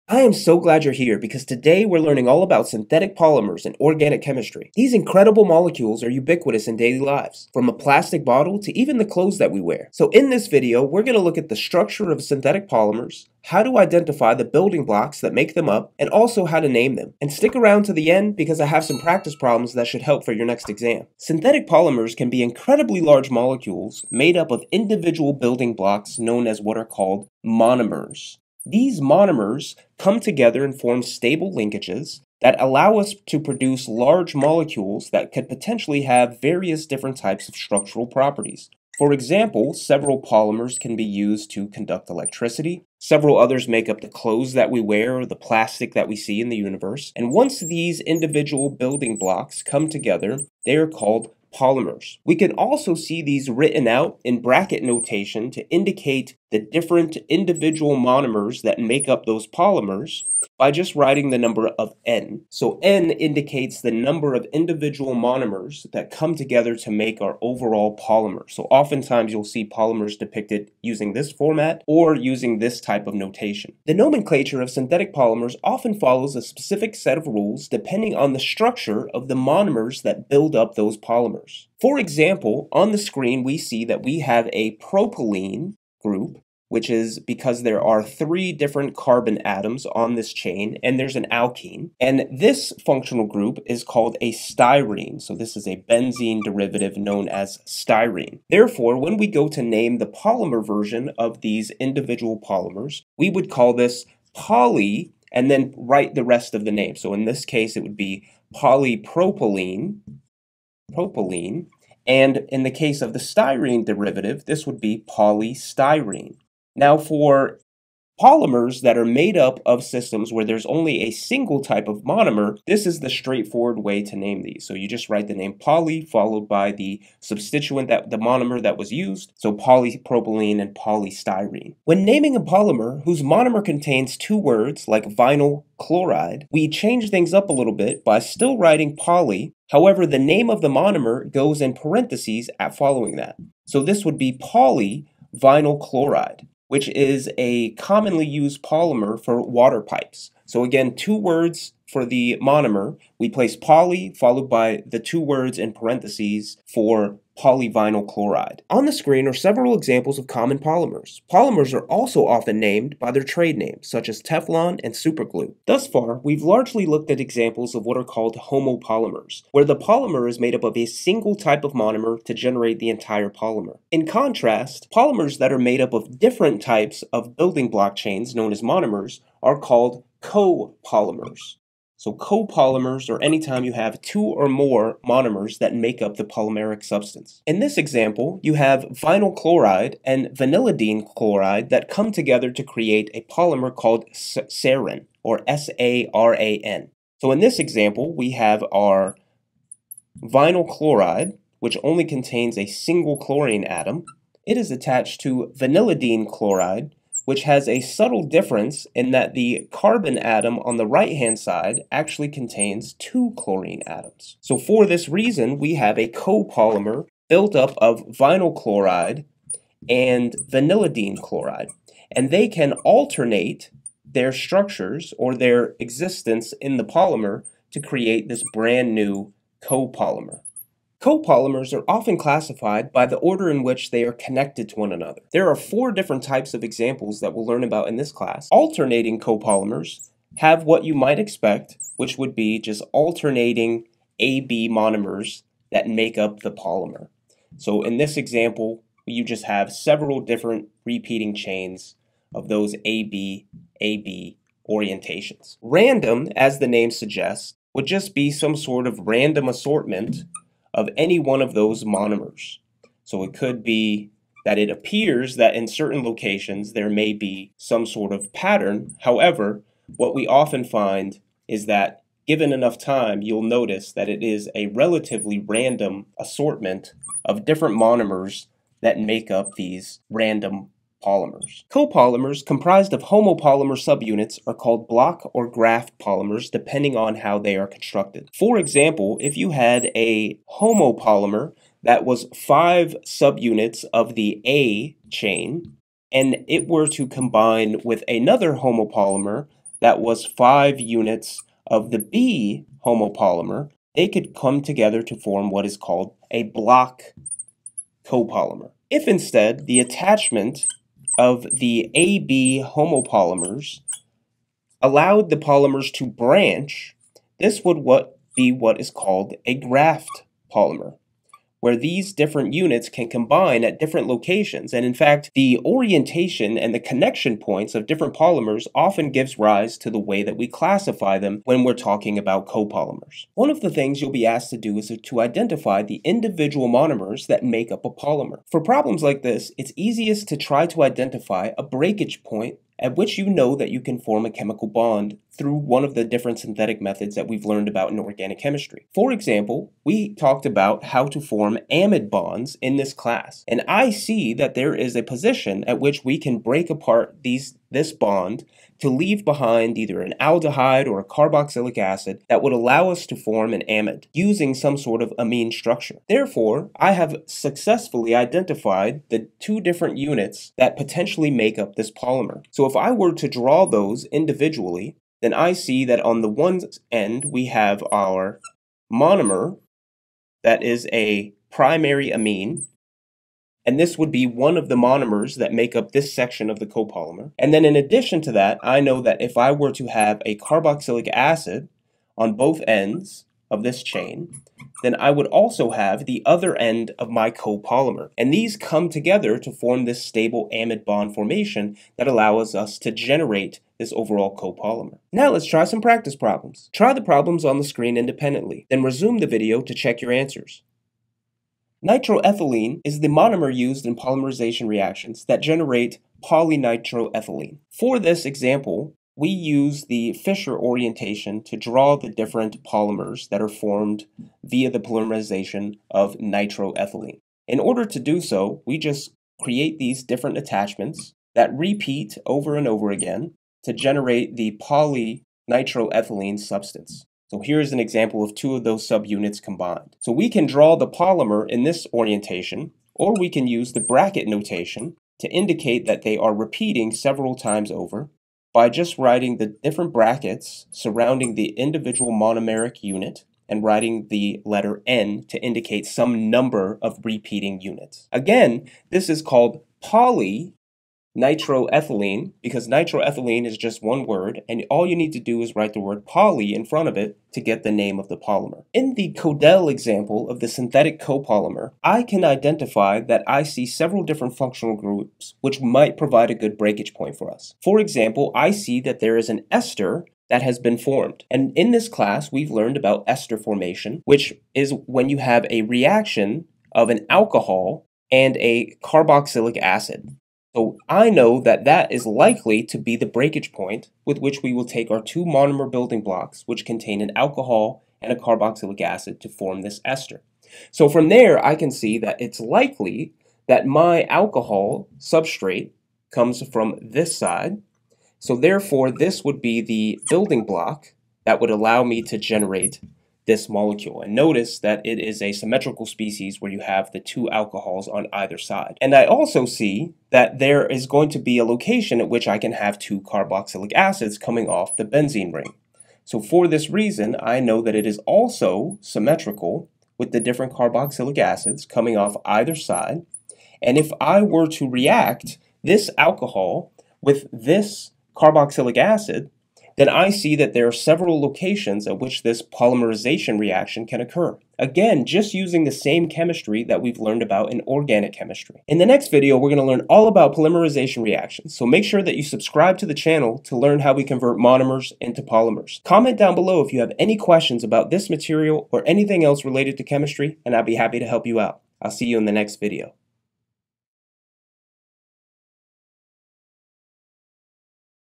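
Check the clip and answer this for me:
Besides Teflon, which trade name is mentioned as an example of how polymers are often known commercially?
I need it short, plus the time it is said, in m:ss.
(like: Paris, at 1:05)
superglue, at 2:44.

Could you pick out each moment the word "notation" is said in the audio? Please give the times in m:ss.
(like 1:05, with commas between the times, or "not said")
0:54, 1:13, 7:24.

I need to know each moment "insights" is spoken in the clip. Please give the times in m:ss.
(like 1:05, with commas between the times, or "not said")
not said.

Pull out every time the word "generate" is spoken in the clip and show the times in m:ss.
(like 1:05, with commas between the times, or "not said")
2:52, 6:42, 6:55, 7:13, 8:32.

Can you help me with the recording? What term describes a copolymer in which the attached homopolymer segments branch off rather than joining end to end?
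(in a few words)
graft polymer.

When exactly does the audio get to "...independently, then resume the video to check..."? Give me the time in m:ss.
6:47.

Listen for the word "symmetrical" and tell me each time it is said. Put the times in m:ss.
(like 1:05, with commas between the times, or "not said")
8:35, 8:48.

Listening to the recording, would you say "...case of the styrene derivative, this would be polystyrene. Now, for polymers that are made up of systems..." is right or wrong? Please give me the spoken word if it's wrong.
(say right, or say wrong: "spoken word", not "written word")
right.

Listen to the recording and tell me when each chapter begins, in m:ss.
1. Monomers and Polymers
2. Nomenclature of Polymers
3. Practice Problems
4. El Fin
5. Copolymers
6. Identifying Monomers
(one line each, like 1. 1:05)
1. 0:21
2. 1:13
3. 6:45
4. 9:08
5. 2:55
6. 5:33.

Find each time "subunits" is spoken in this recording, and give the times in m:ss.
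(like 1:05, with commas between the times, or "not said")
4:43, 4:53, 7:18.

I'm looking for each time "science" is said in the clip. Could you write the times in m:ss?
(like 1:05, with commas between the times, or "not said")
not said.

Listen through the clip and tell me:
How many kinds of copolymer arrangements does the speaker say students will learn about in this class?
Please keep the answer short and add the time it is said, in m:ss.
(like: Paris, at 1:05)
4, at 3:55.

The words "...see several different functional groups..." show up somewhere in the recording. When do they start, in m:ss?
7:53.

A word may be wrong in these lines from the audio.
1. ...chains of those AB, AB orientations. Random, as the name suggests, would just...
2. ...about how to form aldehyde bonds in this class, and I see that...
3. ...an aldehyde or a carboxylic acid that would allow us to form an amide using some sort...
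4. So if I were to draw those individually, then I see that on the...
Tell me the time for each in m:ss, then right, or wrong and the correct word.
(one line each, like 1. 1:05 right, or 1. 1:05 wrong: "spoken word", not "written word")
1. 4:11 right
2. 5:50 wrong: "amide", not "aldehyde"
3. 6:00 right
4. 6:12 right.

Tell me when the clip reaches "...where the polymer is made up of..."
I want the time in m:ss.
2:49.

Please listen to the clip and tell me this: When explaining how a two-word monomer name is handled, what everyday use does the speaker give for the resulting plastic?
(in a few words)
water pipes.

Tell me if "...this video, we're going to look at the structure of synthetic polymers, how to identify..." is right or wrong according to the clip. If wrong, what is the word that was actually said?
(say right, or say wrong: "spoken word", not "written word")
right.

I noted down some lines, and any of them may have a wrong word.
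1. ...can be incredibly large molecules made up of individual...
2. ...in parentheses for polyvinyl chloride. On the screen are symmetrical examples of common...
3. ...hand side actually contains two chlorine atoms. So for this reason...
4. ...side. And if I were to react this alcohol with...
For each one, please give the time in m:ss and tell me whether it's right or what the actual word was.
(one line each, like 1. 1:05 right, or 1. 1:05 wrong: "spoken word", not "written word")
1. 0:22 right
2. 2:35 wrong: "several", not "symmetrical"
3. 3:31 right
4. 8:52 right.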